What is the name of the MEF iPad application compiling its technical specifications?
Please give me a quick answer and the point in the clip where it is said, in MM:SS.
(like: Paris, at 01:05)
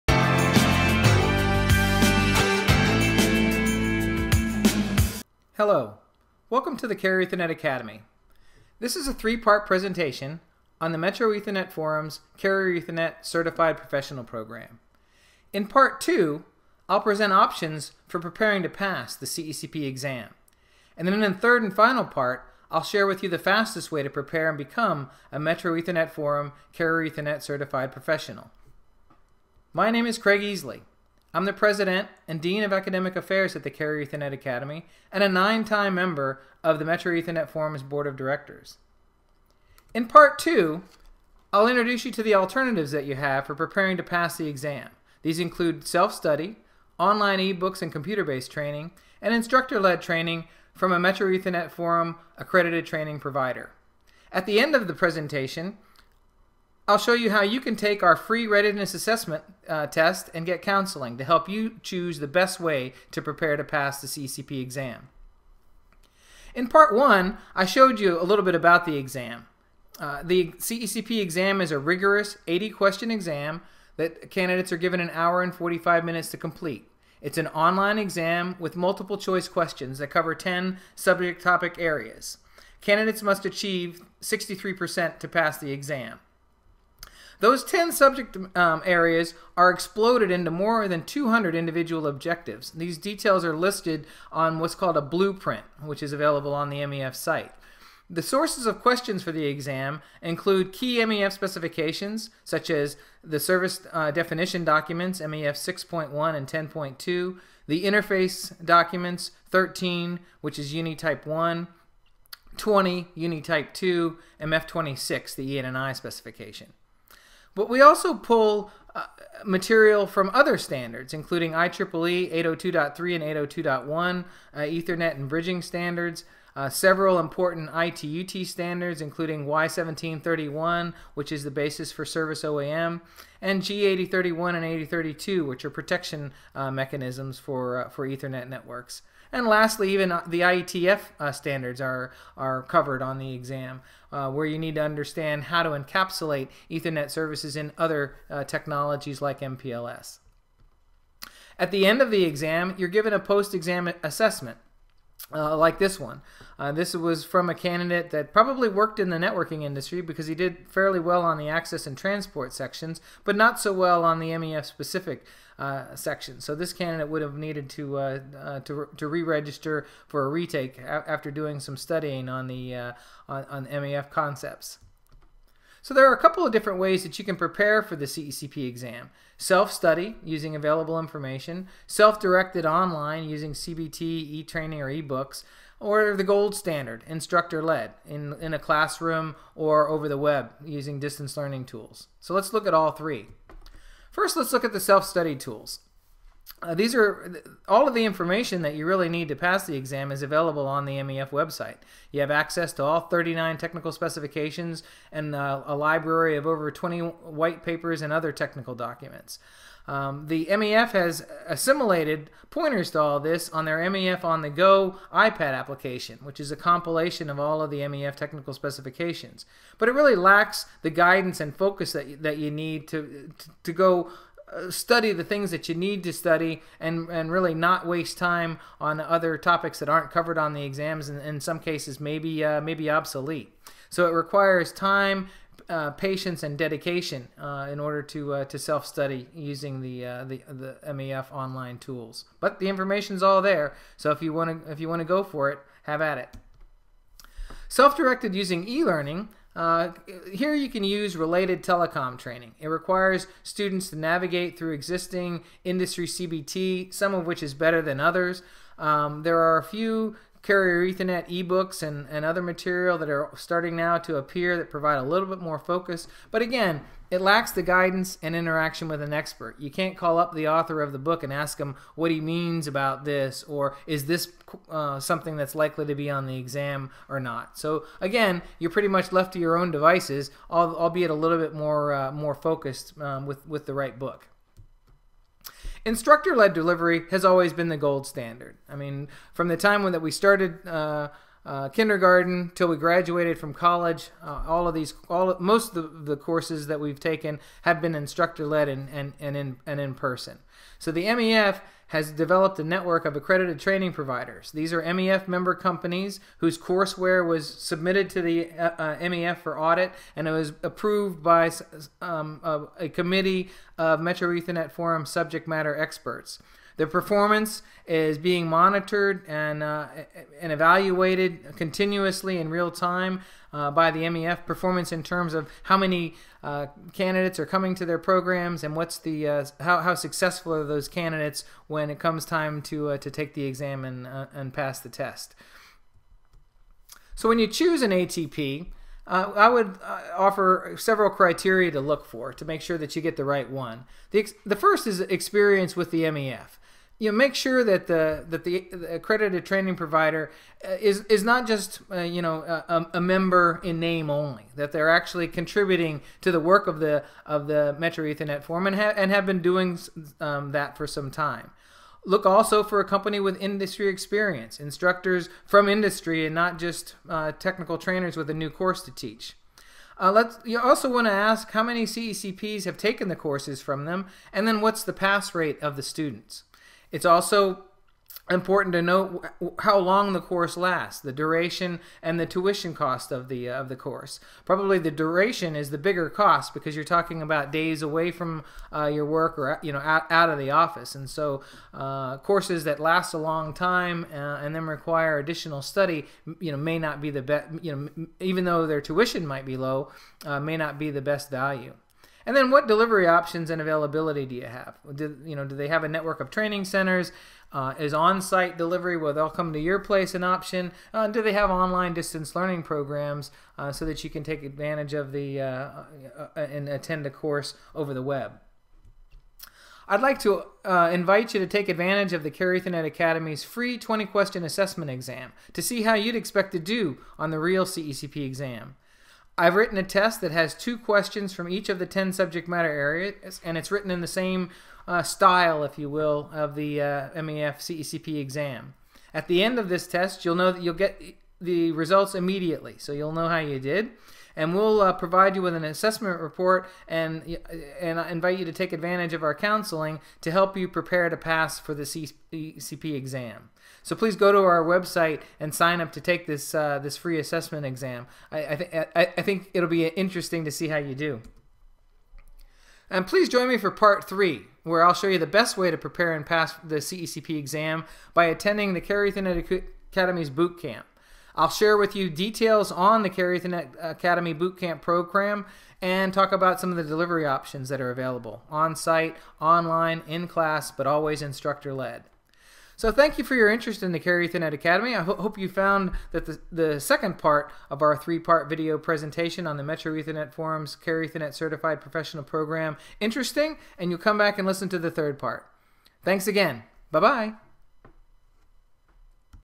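MEF on the go, at 03:33.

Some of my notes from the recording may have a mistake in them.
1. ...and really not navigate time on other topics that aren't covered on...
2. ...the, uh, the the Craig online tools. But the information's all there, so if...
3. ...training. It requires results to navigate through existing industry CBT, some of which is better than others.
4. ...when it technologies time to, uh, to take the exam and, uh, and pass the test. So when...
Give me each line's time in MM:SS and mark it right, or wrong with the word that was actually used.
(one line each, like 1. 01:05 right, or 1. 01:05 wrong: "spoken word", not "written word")
1. 03:47 wrong: "waste", not "navigate"
2. 03:59 wrong: "MEF", not "Craig"
3. 04:12 wrong: "students", not "results"
4. 05:31 wrong: "comes", not "technologies".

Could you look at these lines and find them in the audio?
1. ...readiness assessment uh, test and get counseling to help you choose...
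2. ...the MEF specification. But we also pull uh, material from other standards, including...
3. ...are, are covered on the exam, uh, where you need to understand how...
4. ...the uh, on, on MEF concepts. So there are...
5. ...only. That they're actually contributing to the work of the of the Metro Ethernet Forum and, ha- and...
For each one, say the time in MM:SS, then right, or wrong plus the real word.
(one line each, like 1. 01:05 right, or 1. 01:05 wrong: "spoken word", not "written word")
1. 00:58 right
2. 01:55 wrong: "ENI", not "MEF"
3. 02:21 right
4. 02:52 right
5. 05:54 right.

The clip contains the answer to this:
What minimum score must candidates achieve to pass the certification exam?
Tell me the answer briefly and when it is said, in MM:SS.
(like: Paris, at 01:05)
63%, at 01:24.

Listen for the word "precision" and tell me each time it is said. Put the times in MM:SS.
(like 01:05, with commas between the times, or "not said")
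not said.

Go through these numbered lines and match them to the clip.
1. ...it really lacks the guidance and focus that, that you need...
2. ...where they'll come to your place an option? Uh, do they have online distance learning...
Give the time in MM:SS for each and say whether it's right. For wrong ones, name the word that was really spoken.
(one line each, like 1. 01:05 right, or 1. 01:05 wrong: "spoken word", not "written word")
1. 03:39 right
2. 06:48 right.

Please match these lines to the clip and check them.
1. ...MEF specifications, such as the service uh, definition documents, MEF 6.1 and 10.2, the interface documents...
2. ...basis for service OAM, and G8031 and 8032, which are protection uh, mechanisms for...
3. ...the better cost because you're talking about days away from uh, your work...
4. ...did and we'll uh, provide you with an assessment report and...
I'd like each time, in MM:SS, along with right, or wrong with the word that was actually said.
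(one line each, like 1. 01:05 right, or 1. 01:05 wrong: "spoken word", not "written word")
1. 01:40 right
2. 02:11 right
3. 06:25 wrong: "bigger", not "better"
4. 07:23 right.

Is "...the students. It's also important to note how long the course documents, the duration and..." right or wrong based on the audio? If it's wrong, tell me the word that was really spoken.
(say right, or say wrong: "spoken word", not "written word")
wrong: "lasts", not "documents".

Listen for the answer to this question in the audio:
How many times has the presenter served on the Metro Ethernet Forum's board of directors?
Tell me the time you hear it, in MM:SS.
00:35.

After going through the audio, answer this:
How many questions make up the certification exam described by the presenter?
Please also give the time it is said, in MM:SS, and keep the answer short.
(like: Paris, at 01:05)
80, at 01:12.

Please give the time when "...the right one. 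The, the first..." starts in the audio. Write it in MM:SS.
05:43.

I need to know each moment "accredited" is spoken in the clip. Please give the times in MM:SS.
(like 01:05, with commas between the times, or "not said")
00:52, 05:03, 05:48.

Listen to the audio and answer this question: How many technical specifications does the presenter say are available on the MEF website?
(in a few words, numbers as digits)
39.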